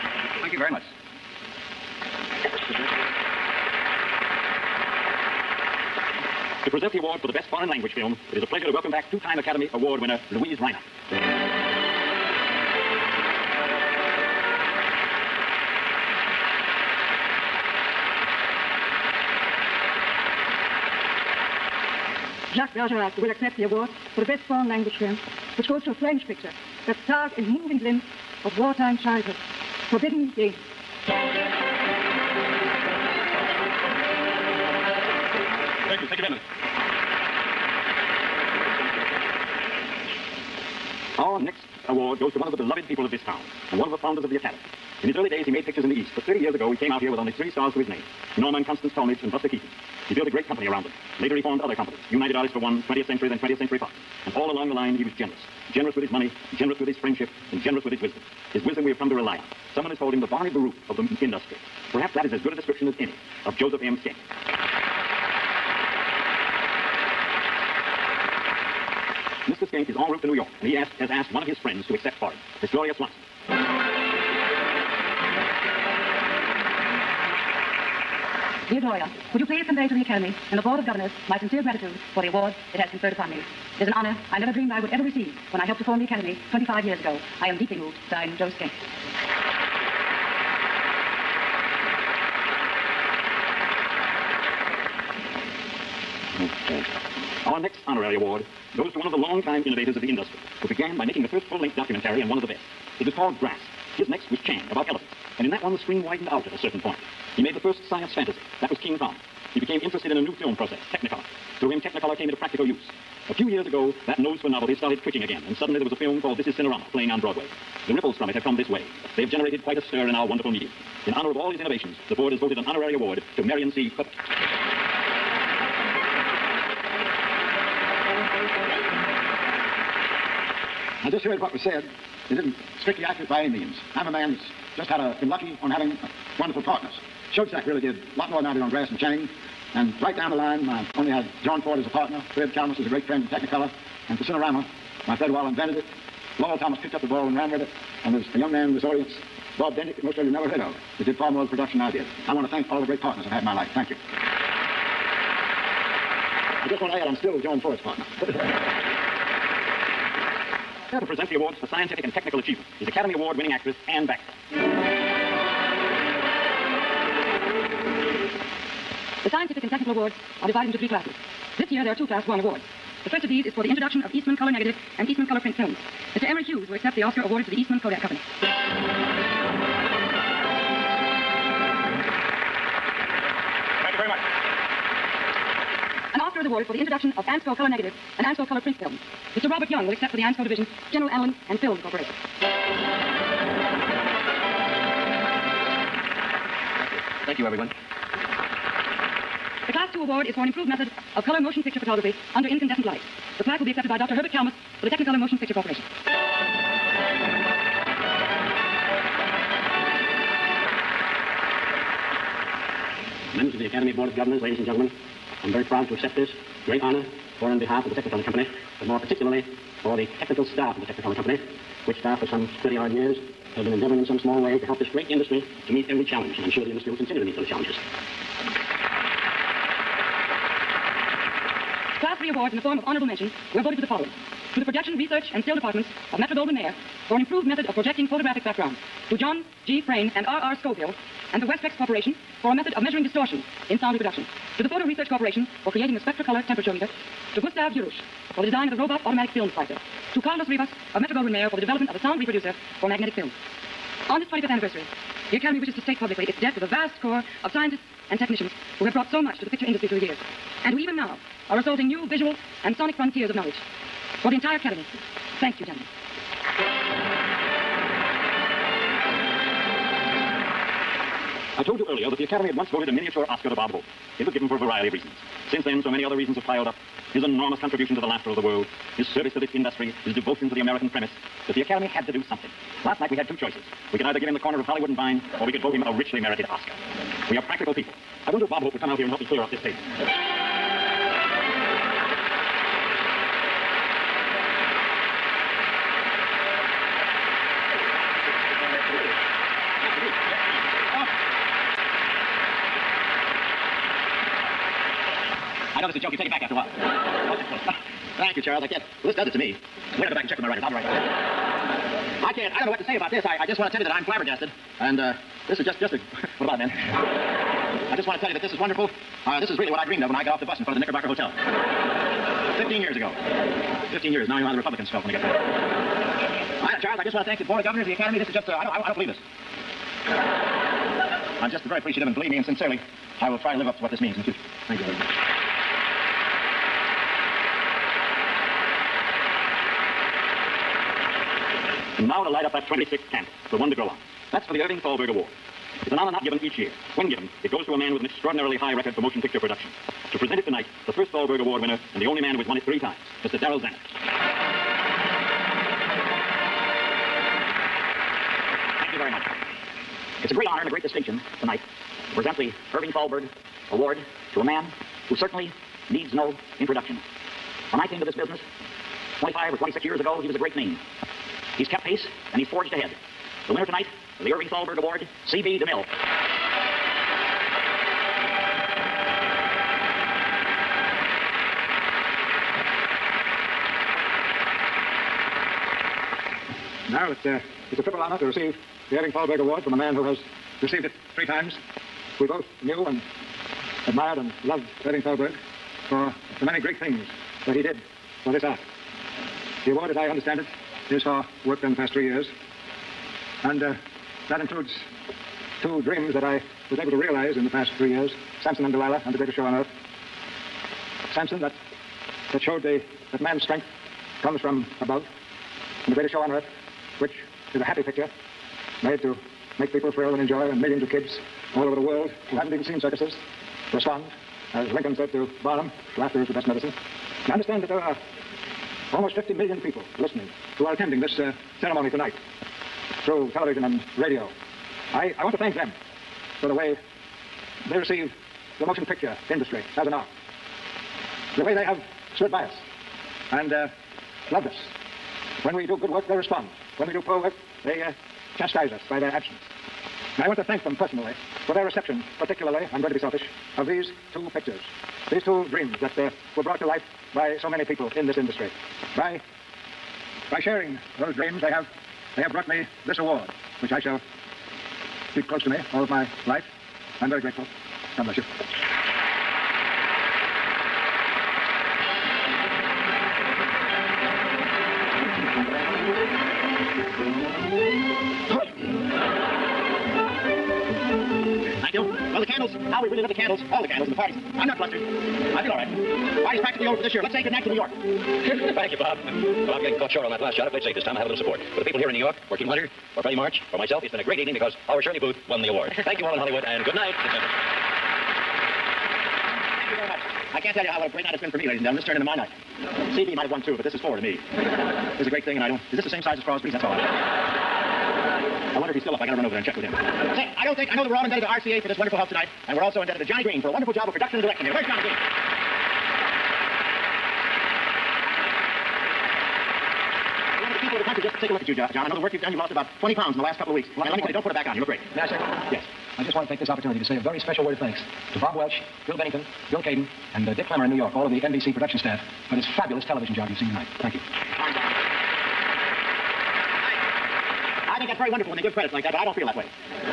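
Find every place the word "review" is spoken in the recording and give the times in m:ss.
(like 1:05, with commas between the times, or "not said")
not said.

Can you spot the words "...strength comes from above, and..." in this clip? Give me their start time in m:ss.
6:53.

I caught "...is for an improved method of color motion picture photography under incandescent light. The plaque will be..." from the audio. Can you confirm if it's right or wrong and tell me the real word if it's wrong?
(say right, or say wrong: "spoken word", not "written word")
right.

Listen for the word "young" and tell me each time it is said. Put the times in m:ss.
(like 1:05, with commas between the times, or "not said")
2:28, 3:09.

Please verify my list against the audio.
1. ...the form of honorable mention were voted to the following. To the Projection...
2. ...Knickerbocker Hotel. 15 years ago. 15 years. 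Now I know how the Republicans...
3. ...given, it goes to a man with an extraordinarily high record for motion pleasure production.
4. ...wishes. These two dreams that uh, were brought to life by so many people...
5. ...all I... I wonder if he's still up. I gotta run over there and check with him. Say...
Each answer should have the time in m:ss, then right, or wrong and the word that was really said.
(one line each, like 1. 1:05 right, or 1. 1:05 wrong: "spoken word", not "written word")
1. 3:52 right
2. 5:20 right
3. 5:47 wrong: "picture", not "pleasure"
4. 7:34 wrong: "pictures", not "wishes"
5. 8:26 right.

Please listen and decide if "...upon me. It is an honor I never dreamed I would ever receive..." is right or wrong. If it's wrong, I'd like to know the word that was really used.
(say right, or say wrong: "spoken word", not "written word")
right.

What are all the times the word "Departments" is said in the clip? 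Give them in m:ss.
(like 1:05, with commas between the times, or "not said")
3:55.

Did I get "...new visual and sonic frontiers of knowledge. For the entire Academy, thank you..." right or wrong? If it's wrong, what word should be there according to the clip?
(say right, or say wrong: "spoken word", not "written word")
right.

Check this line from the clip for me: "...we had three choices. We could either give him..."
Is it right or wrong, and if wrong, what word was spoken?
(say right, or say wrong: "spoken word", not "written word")
wrong: "two", not "three".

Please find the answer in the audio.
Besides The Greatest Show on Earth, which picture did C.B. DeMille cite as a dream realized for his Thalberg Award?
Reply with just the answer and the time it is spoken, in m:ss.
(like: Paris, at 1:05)
Samson and Delilah, at 6:48.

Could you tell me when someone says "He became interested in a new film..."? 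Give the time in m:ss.
1:49.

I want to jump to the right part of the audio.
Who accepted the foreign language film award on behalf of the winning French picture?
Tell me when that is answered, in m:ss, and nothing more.
0:22.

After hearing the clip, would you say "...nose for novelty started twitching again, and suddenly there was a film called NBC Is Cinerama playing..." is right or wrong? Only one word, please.
wrong.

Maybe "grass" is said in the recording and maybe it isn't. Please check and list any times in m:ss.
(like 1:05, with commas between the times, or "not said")
1:43, 2:18.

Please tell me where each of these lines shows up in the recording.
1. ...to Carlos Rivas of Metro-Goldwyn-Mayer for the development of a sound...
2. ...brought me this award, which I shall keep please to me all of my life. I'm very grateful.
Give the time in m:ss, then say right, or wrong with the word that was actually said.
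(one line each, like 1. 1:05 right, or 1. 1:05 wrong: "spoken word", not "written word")
1. 4:10 right
2. 7:42 wrong: "close", not "please".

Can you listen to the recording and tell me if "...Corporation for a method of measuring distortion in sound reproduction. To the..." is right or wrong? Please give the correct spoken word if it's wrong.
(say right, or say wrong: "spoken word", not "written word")
right.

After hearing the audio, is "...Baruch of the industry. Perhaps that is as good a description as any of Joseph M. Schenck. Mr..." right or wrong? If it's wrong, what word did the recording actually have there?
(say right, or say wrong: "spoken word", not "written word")
right.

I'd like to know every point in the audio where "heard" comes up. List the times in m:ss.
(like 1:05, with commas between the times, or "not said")
2:11, 2:30.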